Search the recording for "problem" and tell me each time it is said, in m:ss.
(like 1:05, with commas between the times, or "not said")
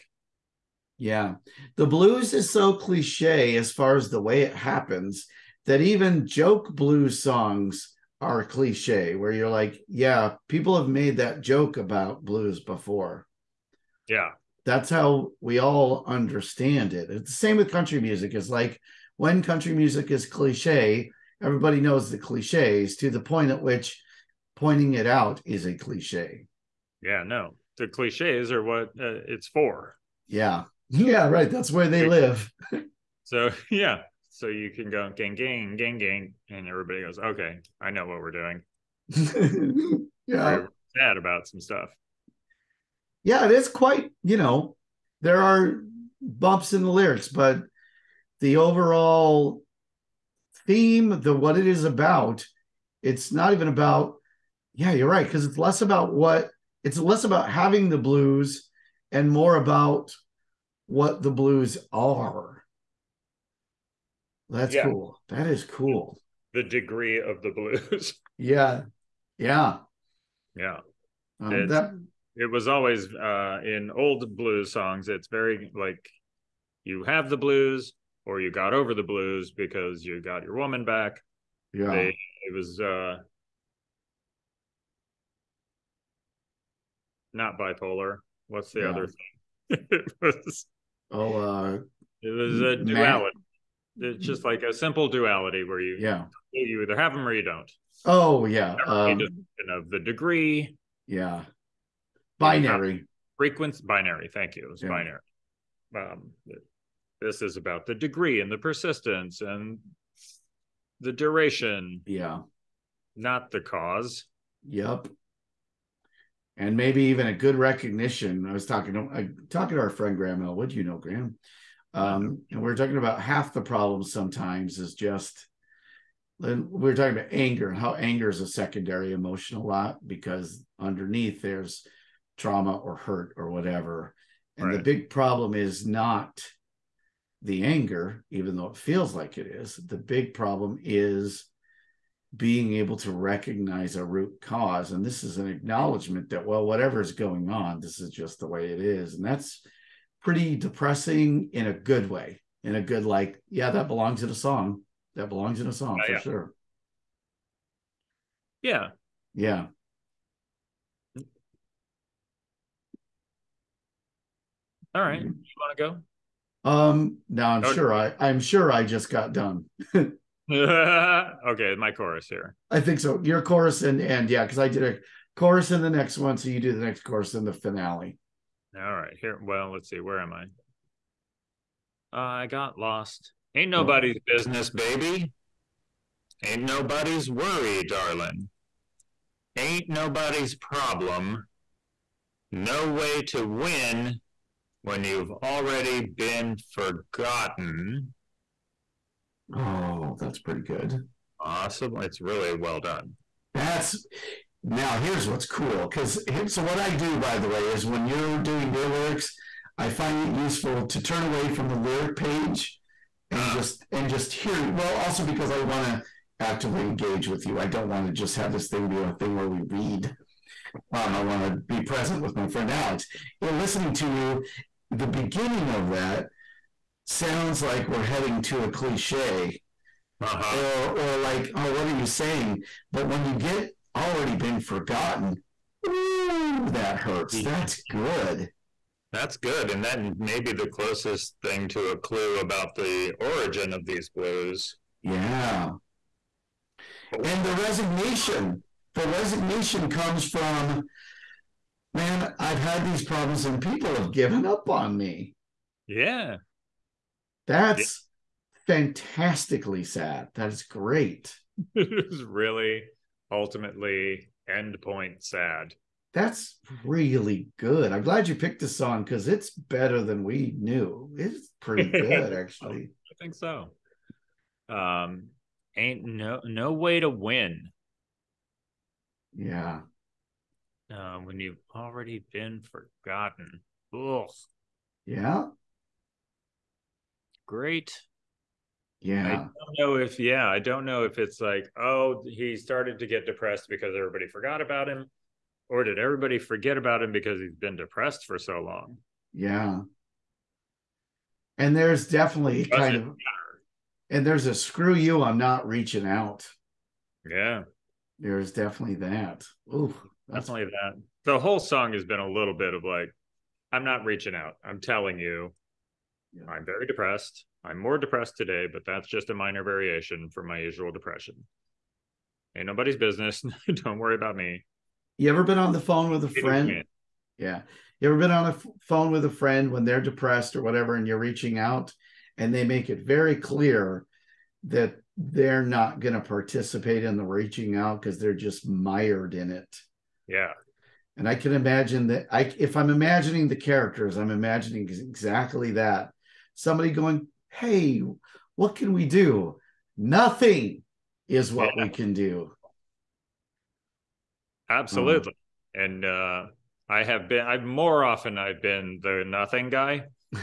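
2:03, 2:15, 2:20, 3:10, 4:13.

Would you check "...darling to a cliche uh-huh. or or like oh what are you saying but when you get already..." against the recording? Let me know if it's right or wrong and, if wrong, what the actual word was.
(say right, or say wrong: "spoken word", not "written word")
wrong: "heading", not "darling".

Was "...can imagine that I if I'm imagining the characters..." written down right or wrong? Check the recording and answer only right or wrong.
right.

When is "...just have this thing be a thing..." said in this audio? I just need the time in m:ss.
3:38.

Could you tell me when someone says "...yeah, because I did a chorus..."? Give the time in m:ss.
2:54.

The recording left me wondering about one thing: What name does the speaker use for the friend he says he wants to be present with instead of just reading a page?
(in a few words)
Alex.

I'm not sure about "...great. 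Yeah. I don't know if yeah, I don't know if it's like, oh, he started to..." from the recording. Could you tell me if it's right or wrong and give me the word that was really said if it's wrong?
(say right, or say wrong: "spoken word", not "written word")
right.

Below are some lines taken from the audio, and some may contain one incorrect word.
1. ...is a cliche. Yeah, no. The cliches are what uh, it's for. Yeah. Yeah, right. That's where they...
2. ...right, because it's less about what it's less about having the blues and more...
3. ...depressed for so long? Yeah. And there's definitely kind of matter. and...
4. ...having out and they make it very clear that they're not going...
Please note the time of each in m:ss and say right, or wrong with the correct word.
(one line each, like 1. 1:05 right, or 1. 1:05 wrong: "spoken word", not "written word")
1. 0:25 right
2. 0:55 right
3. 4:57 right
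4. 5:31 wrong: "reaching", not "having".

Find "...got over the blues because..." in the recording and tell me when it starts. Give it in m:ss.
1:18.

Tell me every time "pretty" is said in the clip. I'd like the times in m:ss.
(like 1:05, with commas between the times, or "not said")
2:30, 3:20, 4:31.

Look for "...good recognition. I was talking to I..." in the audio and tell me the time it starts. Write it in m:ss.
1:57.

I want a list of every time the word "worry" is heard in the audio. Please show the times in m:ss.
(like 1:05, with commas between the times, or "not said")
3:07, 5:23.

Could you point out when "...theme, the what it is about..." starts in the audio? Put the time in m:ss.
0:50.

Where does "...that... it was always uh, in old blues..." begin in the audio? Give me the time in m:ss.
1:11.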